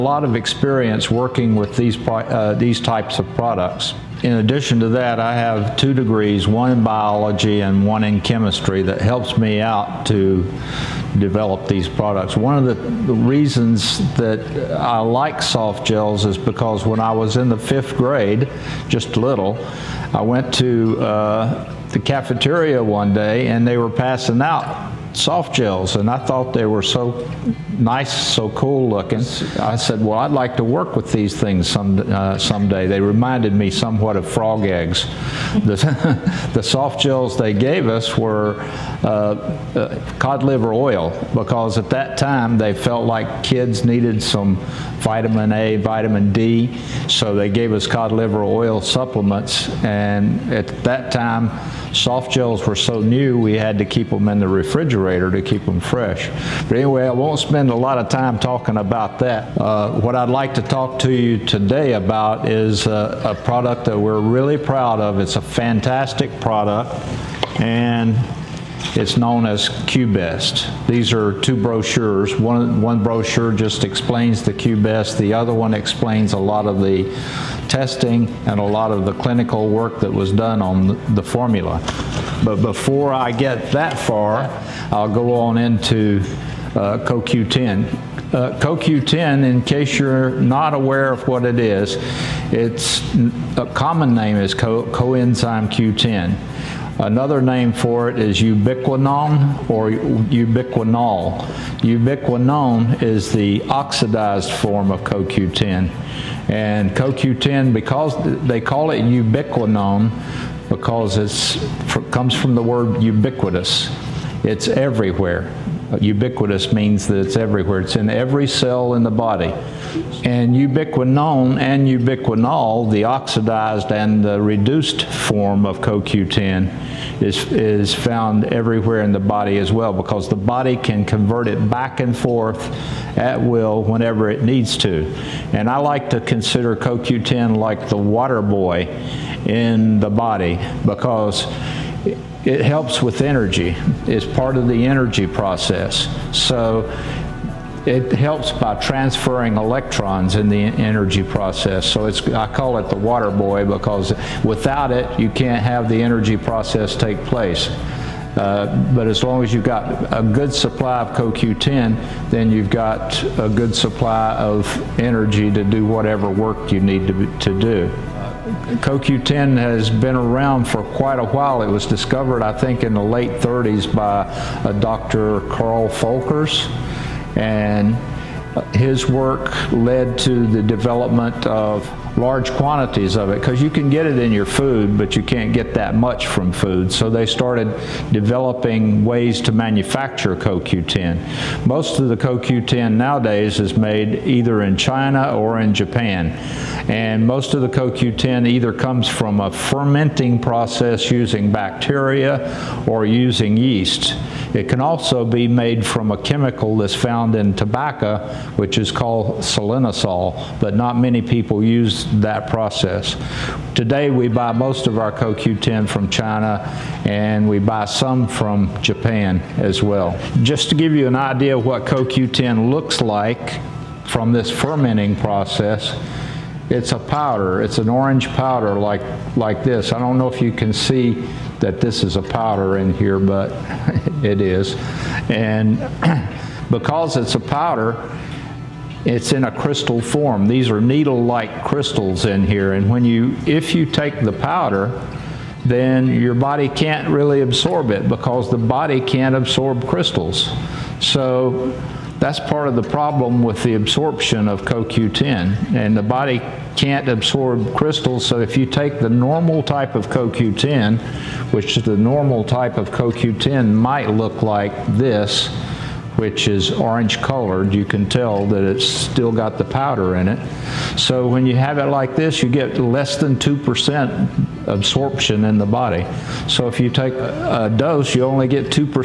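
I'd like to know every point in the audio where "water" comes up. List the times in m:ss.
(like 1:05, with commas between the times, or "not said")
2:17, 2:32.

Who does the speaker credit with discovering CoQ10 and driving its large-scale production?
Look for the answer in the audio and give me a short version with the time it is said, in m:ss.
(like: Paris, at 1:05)
Dr. Carl Folkers, at 2:54.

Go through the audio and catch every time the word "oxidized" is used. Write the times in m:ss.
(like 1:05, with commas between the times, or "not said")
1:43, 2:03.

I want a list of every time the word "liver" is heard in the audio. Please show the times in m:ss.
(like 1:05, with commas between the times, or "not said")
0:40, 0:48.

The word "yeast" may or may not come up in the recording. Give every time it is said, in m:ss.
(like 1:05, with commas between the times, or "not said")
3:23.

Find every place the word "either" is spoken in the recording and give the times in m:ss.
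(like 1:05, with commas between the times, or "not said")
3:14, 3:18.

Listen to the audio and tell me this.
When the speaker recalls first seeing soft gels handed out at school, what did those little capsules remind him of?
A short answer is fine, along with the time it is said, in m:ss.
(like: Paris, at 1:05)
Frog eggs, at 0:34.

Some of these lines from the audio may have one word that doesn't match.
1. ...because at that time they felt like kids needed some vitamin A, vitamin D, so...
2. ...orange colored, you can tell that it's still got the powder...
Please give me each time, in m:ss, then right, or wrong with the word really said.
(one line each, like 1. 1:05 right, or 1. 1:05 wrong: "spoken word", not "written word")
1. 0:41 right
2. 4:26 right.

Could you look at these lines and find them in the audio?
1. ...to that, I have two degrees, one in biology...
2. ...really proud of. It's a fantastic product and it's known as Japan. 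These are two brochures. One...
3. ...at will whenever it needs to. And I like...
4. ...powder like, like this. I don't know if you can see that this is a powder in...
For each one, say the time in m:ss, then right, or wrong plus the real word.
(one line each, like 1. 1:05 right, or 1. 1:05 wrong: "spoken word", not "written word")
1. 0:04 right
2. 1:04 wrong: "QBest", not "Japan"
3. 2:13 right
4. 3:48 right.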